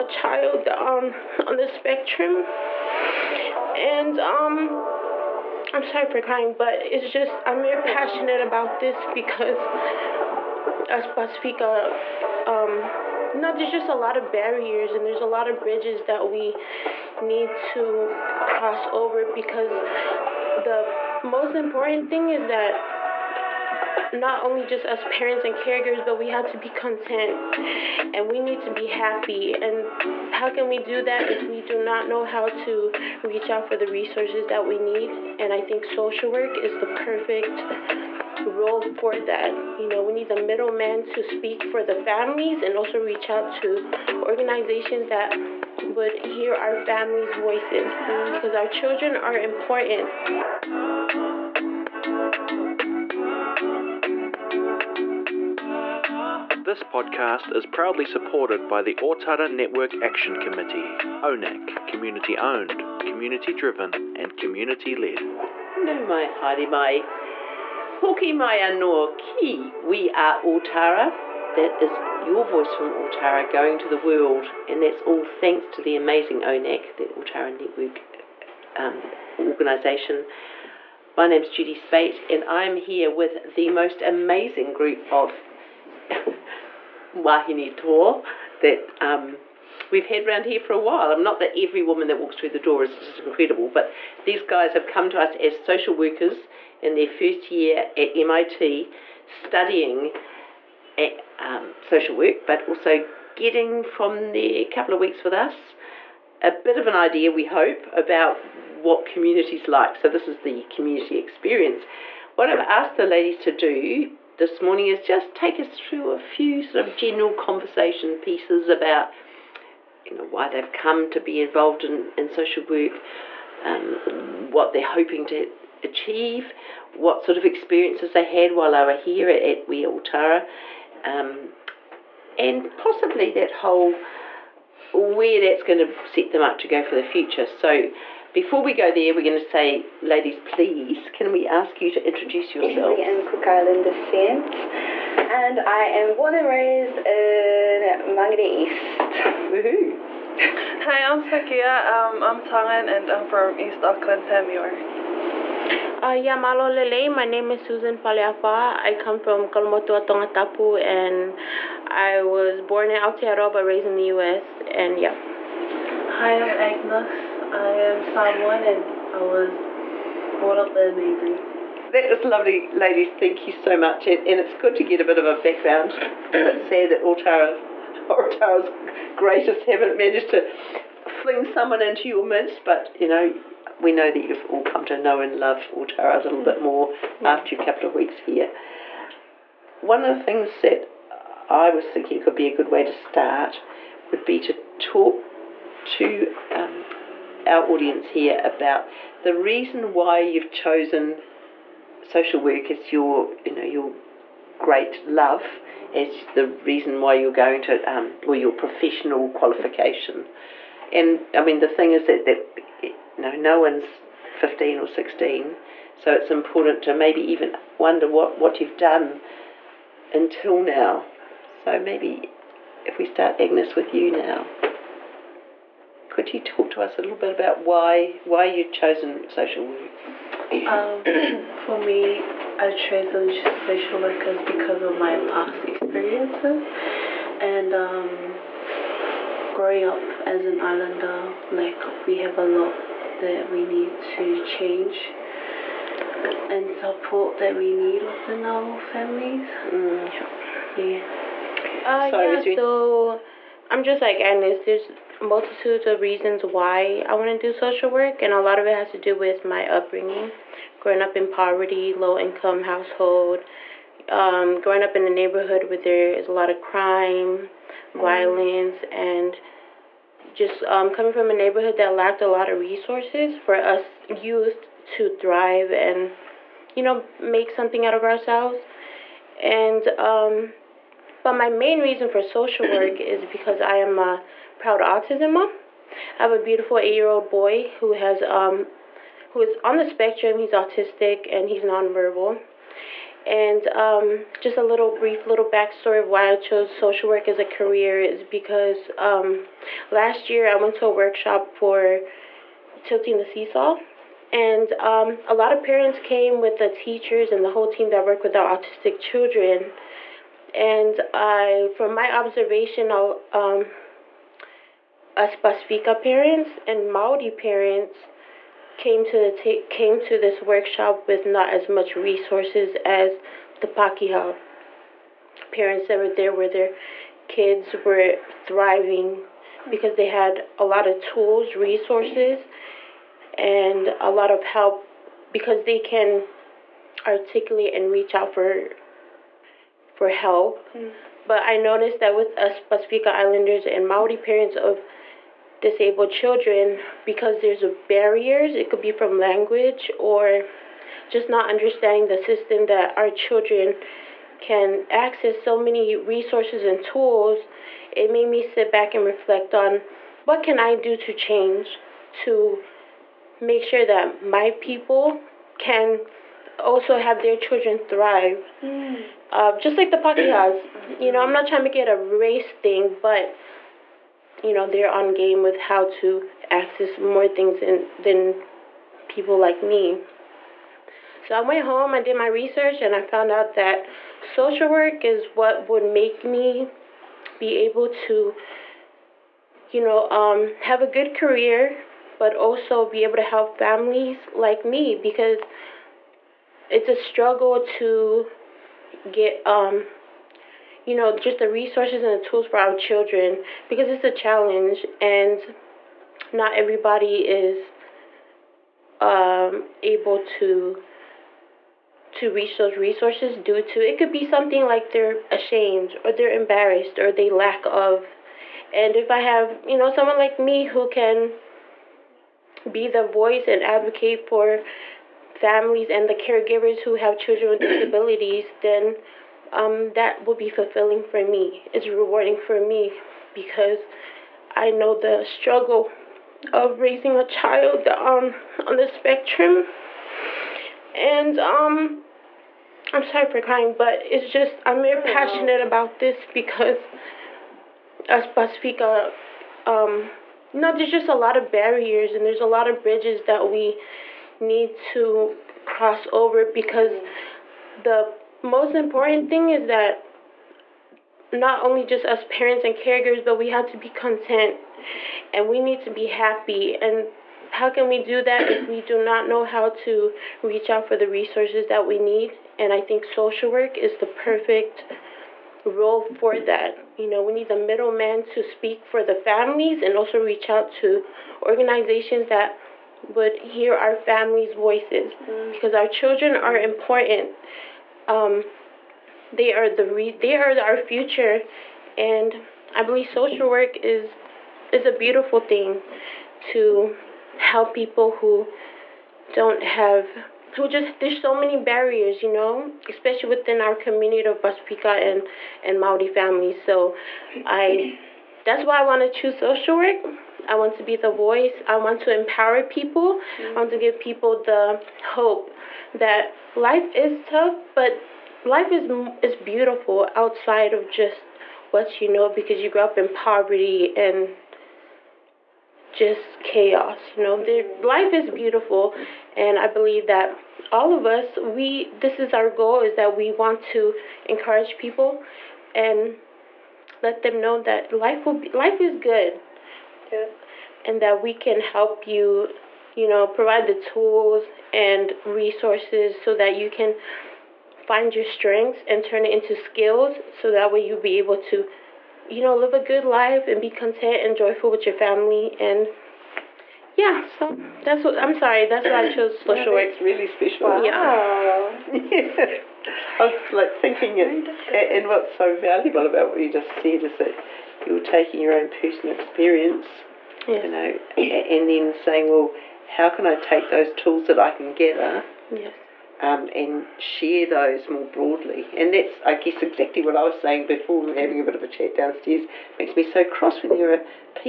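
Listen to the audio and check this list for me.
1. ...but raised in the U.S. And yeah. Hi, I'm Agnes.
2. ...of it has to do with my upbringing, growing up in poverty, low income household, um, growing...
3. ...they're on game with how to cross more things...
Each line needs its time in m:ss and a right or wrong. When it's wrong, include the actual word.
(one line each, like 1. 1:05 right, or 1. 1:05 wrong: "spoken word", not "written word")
1. 2:43 right
2. 4:18 right
3. 6:14 wrong: "access", not "cross".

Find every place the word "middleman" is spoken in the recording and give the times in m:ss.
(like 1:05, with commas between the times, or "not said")
0:40, 7:57.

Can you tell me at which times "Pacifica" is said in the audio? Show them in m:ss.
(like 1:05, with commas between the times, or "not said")
0:11, 5:15, 5:42, 7:28, 8:24.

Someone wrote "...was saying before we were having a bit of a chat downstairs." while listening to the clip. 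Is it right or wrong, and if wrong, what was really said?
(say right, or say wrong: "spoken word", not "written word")
right.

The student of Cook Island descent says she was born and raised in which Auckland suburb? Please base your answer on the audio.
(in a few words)
Mangere East.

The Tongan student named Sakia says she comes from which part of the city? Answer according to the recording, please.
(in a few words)
East Auckland.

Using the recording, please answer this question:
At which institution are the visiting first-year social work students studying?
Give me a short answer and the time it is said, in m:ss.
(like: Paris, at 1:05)
MIT, at 1:38.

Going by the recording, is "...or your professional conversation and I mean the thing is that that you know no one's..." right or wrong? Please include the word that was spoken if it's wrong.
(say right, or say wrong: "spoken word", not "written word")
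wrong: "qualification", not "conversation".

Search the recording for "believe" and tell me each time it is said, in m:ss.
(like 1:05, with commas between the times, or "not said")
8:12, 8:49.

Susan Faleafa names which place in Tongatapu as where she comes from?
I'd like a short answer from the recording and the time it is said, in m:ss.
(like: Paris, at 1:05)
Kolomotu'a, at 2:39.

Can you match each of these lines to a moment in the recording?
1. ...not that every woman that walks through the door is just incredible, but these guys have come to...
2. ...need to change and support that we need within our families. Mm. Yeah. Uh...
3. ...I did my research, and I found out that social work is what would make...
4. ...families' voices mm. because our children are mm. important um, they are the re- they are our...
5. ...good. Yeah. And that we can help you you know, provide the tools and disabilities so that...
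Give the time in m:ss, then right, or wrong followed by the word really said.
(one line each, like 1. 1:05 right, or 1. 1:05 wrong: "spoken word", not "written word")
1. 1:31 right
2. 4:03 right
3. 6:21 right
4. 8:03 right
5. 8:58 wrong: "resources", not "disabilities".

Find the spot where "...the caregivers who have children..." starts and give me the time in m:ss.
7:06.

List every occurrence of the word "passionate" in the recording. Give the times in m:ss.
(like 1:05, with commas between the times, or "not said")
0:07, 7:25.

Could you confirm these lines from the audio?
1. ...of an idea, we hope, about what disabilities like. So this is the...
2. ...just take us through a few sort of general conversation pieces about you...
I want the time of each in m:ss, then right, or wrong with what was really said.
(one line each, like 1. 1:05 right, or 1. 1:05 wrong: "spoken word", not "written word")
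1. 1:46 wrong: "communities", not "disabilities"
2. 1:55 right.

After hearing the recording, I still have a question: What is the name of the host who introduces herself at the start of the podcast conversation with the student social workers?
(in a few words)
Judy Spate.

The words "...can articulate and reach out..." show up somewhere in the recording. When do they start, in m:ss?
5:35.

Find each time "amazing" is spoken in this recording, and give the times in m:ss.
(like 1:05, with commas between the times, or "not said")
1:15, 1:24.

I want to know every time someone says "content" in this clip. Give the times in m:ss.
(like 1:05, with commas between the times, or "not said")
0:26, 7:43, 9:13.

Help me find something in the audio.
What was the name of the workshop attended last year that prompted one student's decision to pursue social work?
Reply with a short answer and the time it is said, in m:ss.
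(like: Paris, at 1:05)
Tilting the Seesaw, at 5:02.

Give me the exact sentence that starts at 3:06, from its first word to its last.
bit more after a couple of weeks here.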